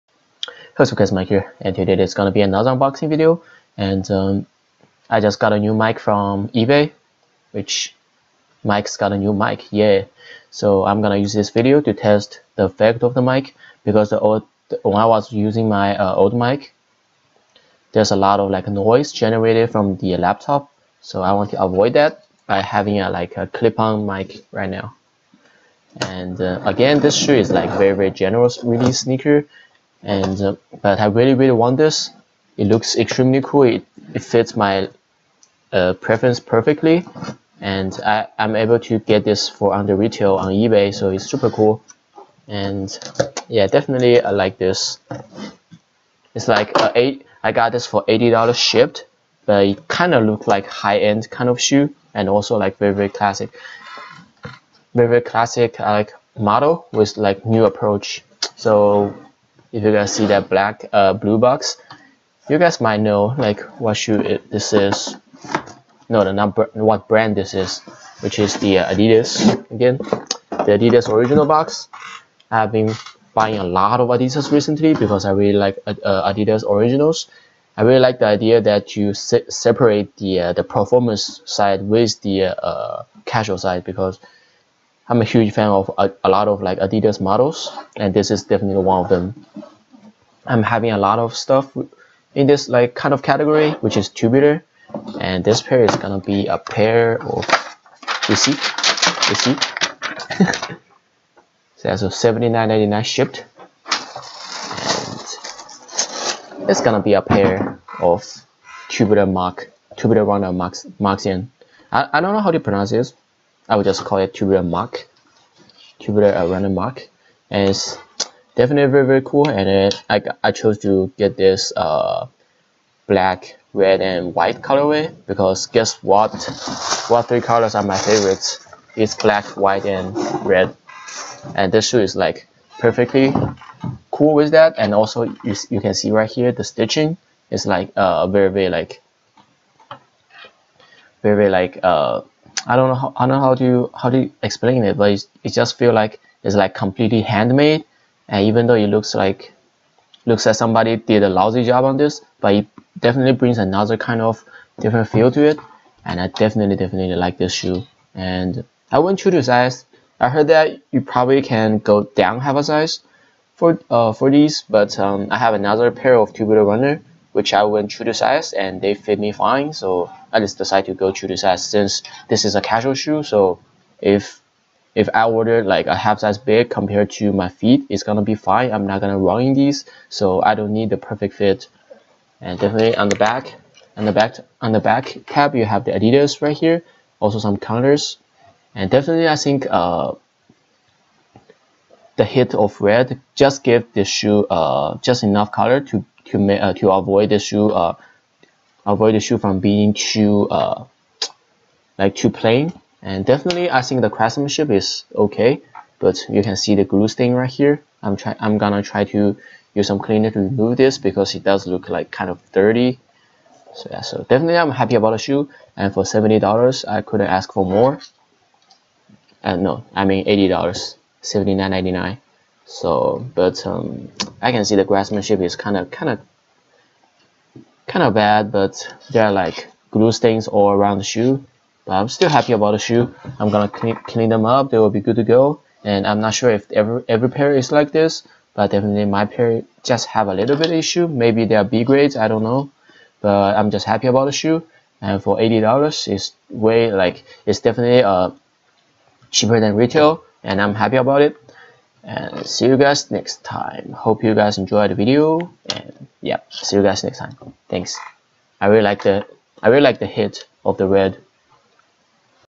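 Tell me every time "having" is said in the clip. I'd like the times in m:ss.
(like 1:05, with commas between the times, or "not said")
0:22, 1:30.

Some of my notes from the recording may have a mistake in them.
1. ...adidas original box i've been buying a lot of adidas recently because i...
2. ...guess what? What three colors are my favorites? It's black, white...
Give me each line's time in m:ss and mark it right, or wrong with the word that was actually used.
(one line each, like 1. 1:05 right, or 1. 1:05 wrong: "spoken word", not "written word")
1. 1:10 right
2. 2:05 right.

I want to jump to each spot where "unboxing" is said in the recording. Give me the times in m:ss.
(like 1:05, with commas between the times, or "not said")
0:02.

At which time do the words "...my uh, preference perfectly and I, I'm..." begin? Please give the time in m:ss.
0:34.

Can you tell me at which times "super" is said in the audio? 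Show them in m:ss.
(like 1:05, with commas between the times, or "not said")
0:41.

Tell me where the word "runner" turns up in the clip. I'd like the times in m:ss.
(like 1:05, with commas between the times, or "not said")
1:50, 2:46.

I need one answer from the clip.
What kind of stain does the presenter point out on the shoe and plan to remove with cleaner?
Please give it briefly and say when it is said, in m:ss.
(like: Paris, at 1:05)
Glue stain, at 3:26.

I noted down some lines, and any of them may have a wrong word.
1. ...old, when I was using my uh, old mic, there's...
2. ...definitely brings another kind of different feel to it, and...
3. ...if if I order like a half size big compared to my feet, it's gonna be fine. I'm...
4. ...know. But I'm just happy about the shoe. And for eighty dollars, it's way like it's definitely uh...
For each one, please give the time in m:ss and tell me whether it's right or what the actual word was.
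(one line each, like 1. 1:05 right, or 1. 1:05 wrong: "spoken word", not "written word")
1. 0:14 right
2. 2:32 right
3. 2:53 right
4. 4:02 right.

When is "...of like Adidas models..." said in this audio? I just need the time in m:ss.
1:26.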